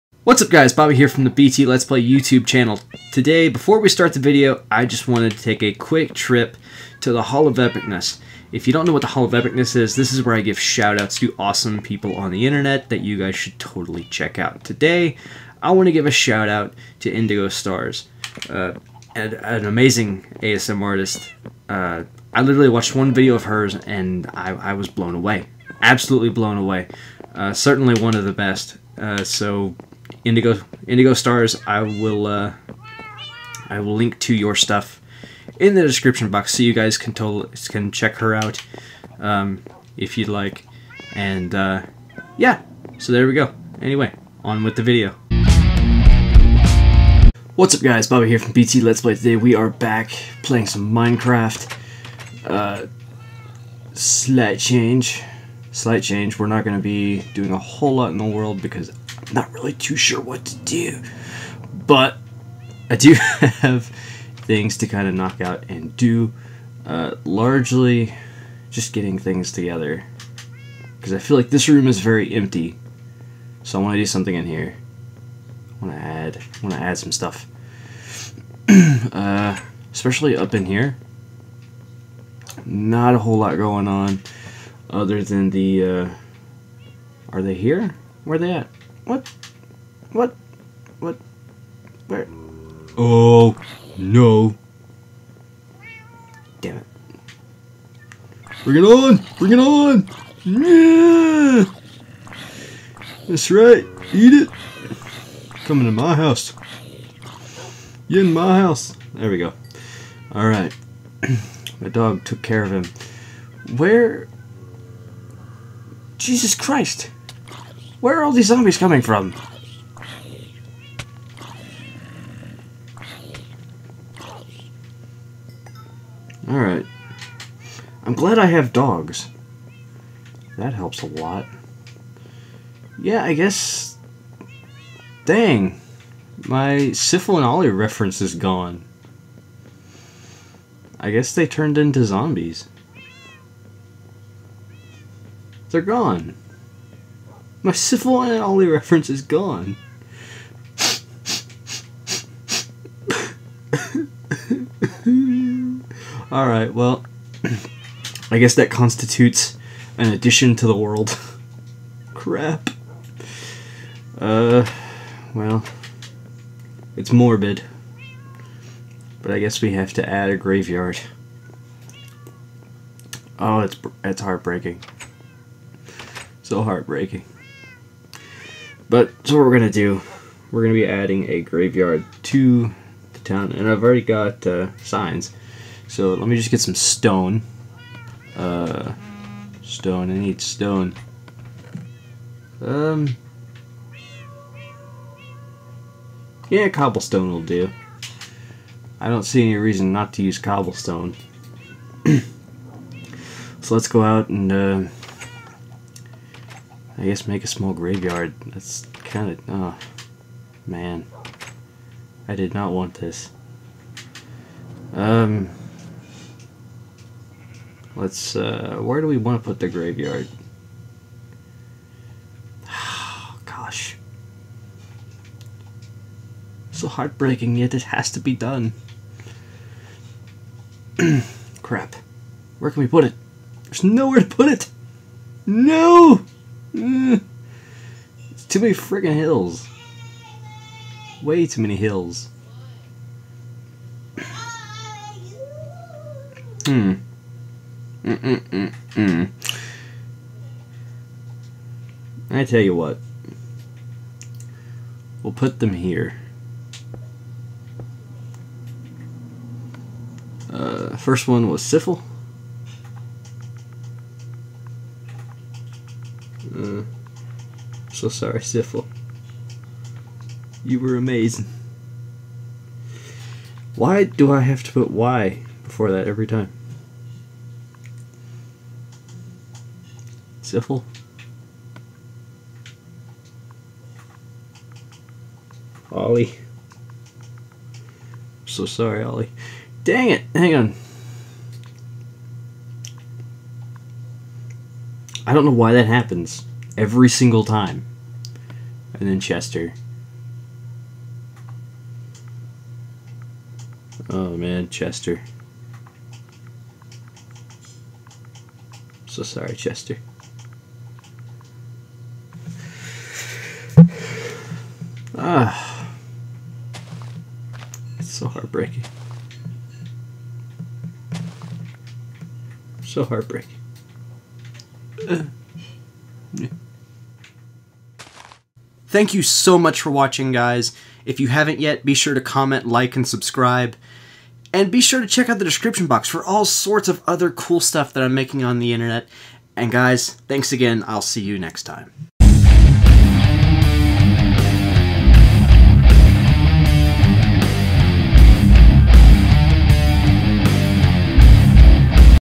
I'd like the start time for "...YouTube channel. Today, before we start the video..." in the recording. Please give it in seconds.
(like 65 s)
2 s.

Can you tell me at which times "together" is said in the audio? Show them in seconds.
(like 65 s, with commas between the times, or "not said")
69 s.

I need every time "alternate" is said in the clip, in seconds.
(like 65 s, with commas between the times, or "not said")
not said.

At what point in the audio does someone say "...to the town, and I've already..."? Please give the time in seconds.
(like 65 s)
182 s.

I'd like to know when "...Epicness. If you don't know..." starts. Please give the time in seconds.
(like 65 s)
7 s.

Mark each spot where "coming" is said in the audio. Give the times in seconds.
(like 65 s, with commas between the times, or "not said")
105 s, 118 s.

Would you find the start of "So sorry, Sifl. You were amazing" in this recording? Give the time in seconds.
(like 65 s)
267 s.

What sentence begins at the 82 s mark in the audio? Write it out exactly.
Not a whole lot going on other than the, uh, are they here?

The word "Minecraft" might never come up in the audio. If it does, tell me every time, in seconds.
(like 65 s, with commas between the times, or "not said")
50 s.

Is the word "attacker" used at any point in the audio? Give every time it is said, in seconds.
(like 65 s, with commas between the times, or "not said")
not said.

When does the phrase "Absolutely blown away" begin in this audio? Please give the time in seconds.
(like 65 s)
25 s.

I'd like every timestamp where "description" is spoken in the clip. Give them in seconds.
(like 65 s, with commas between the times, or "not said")
35 s, 335 s.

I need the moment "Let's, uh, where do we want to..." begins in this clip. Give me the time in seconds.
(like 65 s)
217 s.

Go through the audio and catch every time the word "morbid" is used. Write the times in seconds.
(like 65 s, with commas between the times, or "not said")
167 s.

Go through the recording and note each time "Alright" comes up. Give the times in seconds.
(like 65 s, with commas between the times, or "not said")
110 s, 126 s, 156 s.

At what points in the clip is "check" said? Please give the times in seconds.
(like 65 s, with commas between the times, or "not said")
14 s, 37 s, 335 s.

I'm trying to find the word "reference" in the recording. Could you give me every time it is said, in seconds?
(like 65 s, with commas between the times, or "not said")
137 s, 148 s.